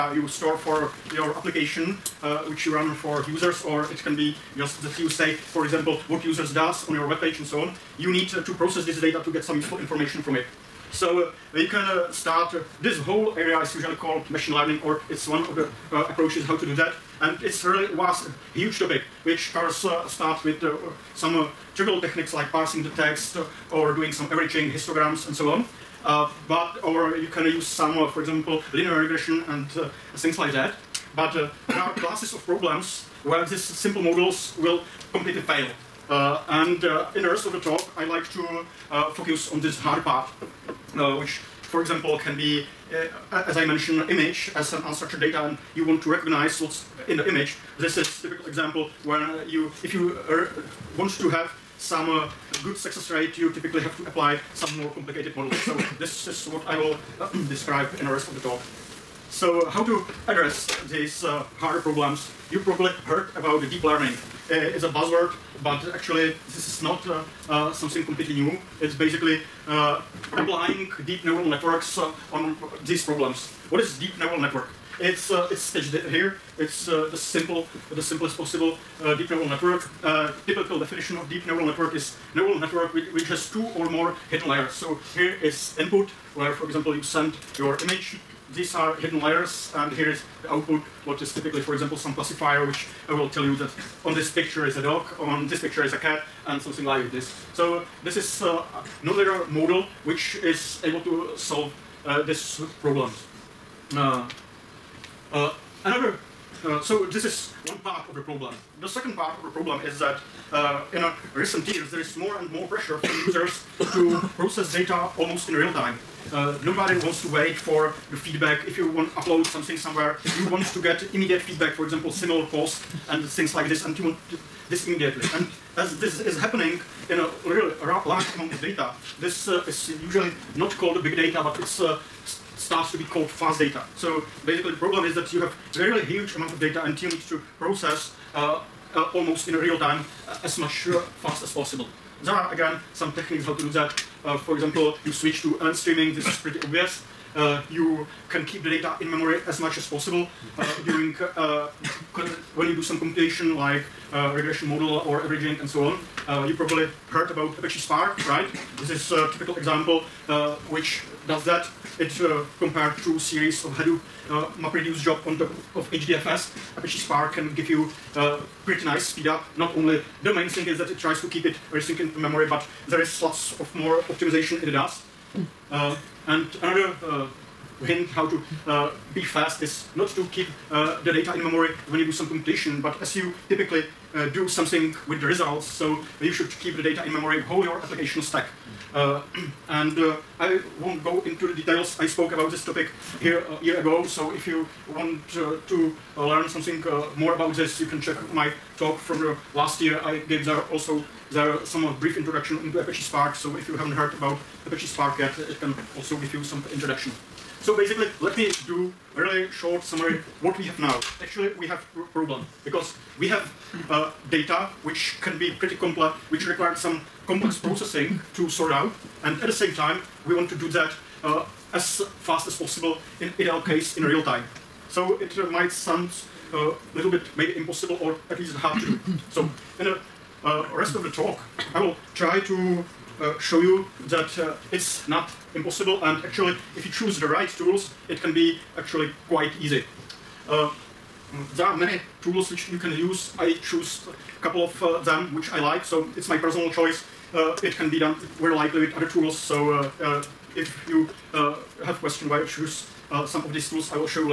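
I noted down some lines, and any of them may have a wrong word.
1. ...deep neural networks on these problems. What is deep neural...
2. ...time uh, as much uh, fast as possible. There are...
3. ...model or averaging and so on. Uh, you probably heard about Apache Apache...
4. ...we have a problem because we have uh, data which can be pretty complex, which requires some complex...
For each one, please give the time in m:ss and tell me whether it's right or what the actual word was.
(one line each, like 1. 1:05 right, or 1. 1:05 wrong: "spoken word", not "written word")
1. 1:11 right
2. 2:19 right
3. 2:34 wrong: "Spark", not "Apache"
4. 3:31 right.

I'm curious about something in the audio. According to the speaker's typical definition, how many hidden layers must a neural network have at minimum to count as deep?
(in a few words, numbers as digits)
2.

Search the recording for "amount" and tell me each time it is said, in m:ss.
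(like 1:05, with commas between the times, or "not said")
2:08, 2:16.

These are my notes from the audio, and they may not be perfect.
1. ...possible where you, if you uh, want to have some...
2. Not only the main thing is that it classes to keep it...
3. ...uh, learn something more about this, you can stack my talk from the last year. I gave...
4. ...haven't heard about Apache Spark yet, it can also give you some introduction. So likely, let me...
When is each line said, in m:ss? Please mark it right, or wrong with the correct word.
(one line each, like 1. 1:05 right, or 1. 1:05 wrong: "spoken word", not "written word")
1. 0:48 wrong: "example", not "possible"
2. 2:49 wrong: "tries", not "classes"
3. 3:16 wrong: "check", not "stack"
4. 3:23 wrong: "basically", not "likely".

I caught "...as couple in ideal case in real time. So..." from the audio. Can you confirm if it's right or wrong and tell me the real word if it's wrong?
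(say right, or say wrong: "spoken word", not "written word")
wrong: "possible", not "couple".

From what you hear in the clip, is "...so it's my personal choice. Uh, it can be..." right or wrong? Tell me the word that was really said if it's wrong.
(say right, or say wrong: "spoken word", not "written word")
right.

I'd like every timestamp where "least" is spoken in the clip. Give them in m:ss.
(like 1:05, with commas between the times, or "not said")
3:48.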